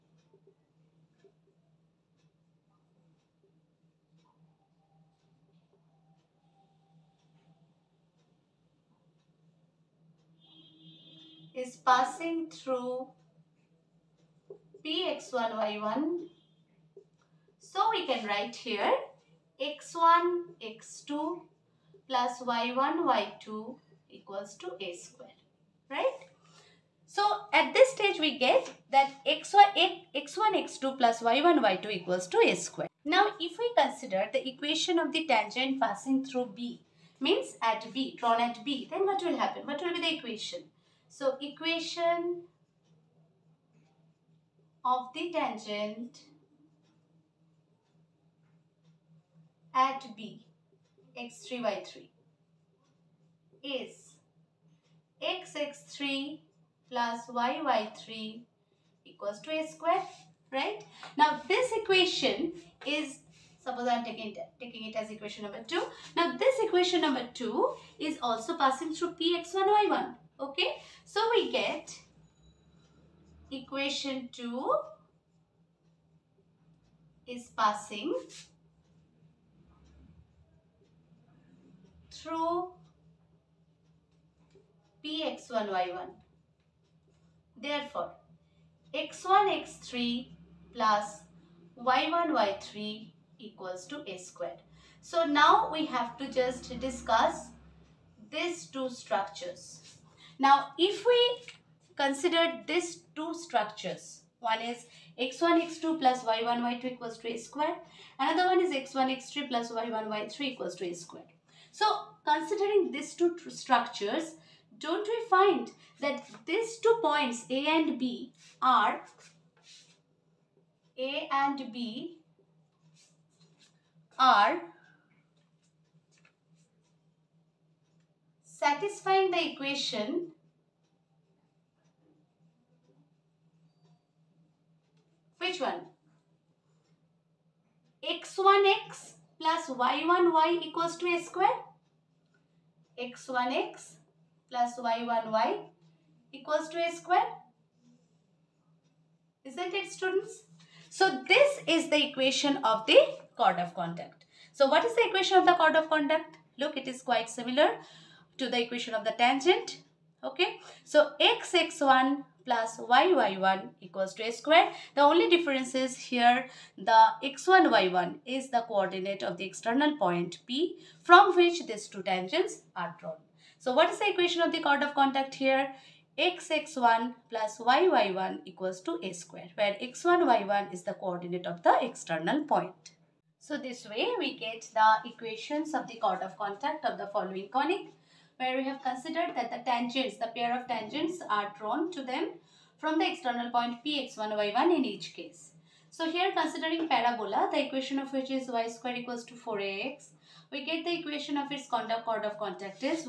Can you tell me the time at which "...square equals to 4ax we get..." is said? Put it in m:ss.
3:18.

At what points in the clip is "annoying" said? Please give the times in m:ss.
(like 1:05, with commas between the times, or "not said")
not said.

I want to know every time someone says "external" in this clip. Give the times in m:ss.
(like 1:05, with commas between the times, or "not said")
2:49, 3:01, 3:13.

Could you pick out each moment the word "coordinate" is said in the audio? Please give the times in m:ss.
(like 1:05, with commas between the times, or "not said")
2:48, 3:00.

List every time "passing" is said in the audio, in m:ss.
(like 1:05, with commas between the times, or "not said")
0:11, 0:35, 1:08, 1:17.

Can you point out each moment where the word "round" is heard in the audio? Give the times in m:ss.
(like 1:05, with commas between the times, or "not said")
not said.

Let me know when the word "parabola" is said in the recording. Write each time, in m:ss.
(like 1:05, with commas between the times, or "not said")
3:16.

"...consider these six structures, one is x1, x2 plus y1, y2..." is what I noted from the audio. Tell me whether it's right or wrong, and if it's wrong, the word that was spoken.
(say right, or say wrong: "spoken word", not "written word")
wrong: "two", not "six".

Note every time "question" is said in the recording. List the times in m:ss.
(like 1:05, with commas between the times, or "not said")
not said.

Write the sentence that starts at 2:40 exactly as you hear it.
Okay, so x x1 plus y y1 equals to a square.